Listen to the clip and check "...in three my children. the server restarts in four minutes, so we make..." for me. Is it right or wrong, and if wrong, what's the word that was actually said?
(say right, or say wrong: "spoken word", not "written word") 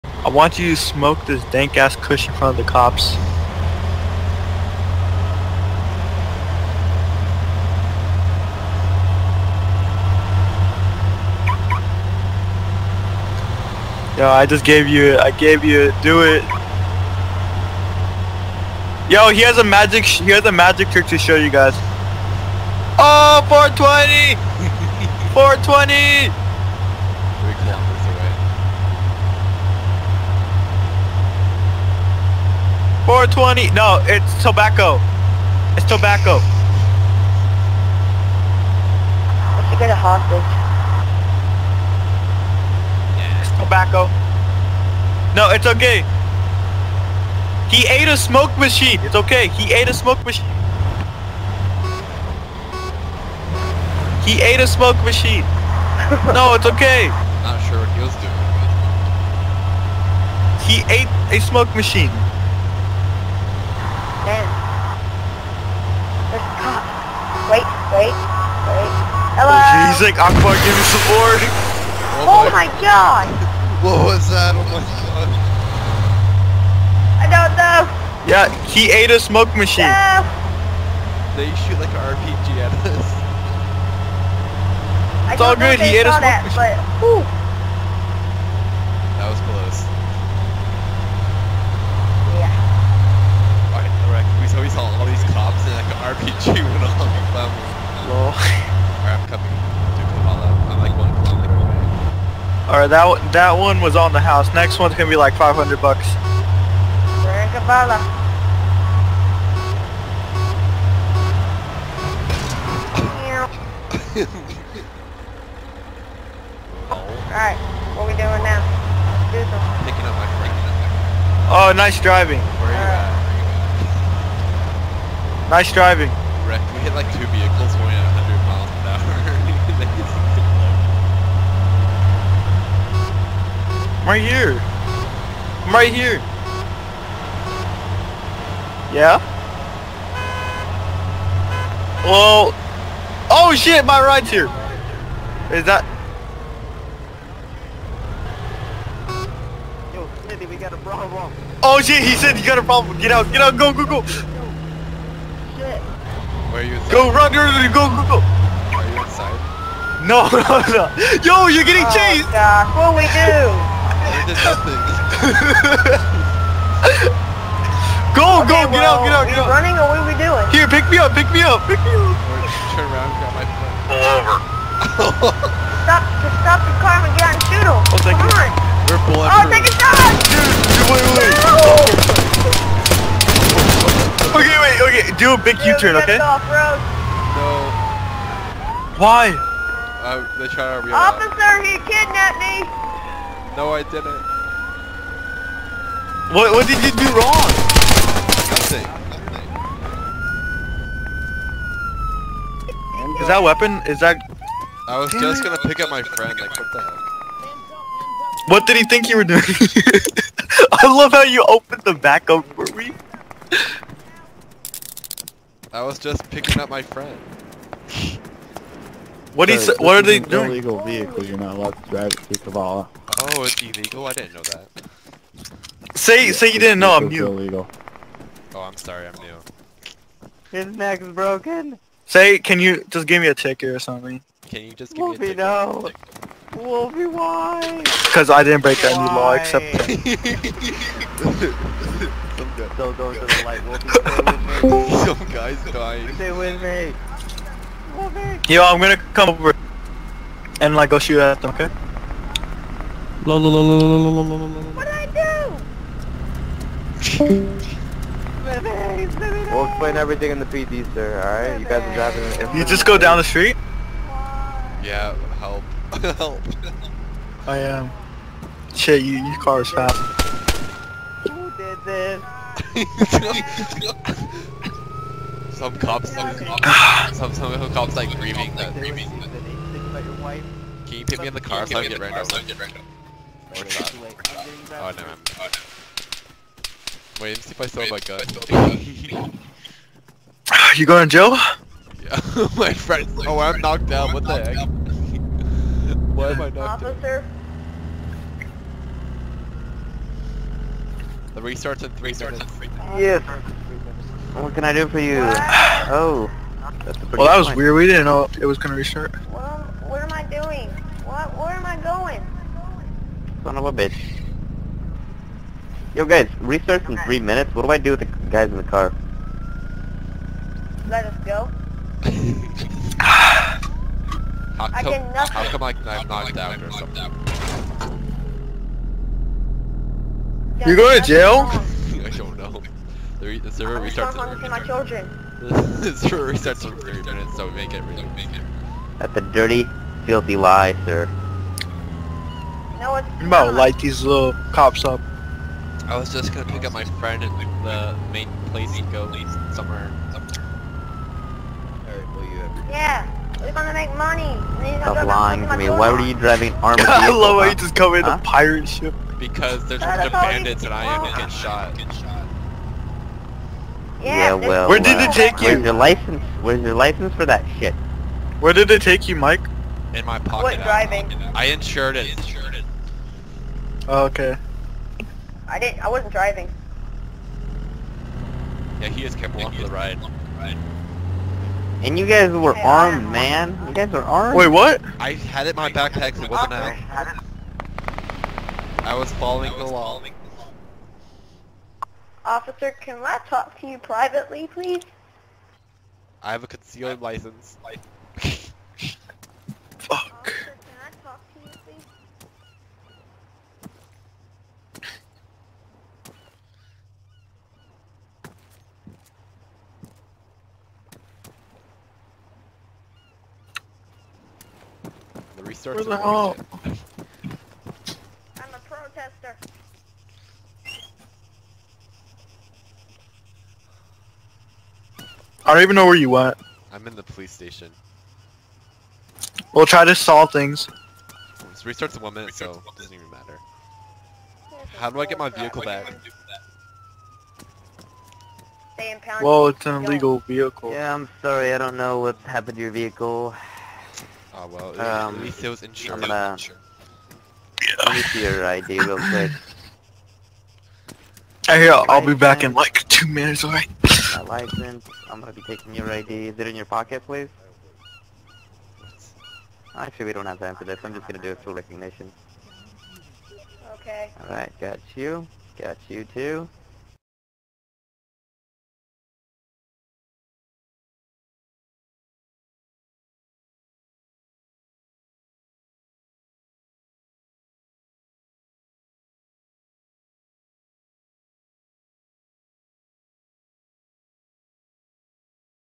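wrong: "three", not "four".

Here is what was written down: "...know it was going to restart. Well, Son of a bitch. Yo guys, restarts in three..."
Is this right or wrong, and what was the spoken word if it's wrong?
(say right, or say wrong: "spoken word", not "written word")
right.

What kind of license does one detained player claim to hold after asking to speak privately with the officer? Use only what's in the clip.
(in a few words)
concealed license.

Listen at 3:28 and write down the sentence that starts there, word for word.
What did he think you were doing?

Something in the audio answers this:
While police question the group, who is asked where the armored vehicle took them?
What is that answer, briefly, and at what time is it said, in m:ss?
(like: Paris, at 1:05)
Mike, at 6:09.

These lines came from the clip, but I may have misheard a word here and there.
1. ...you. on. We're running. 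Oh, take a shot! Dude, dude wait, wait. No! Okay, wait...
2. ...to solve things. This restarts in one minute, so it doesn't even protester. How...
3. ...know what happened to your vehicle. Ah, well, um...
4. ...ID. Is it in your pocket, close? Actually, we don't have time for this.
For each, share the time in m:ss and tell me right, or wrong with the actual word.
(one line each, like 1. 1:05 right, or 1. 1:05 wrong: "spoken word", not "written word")
1. 2:58 wrong: "pulling", not "running"
2. 7:09 wrong: "matter", not "protester"
3. 7:21 right
4. 7:35 wrong: "please", not "close".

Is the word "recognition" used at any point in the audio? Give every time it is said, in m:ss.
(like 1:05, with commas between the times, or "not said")
7:41.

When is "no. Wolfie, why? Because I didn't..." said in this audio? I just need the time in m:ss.
3:55.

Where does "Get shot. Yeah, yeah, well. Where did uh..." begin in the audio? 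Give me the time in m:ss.
6:01.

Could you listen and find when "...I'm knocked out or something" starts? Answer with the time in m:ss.
5:25.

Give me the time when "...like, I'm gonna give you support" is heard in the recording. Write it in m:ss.
1:10.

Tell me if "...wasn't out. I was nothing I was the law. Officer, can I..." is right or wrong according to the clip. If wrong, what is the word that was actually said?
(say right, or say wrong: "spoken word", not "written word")
wrong: "following", not "nothing".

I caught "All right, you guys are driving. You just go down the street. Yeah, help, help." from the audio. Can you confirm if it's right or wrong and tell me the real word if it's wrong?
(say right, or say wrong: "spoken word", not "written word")
right.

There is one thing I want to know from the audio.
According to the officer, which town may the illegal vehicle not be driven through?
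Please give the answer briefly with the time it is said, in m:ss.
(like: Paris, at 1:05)
Kavala, at 3:42.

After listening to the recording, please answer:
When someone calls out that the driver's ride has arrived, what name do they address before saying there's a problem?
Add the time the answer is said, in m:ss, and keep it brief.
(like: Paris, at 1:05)
Smithy, at 2:30.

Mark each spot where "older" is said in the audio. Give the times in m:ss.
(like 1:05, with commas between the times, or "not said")
not said.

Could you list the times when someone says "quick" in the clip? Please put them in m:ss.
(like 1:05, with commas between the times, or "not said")
7:28.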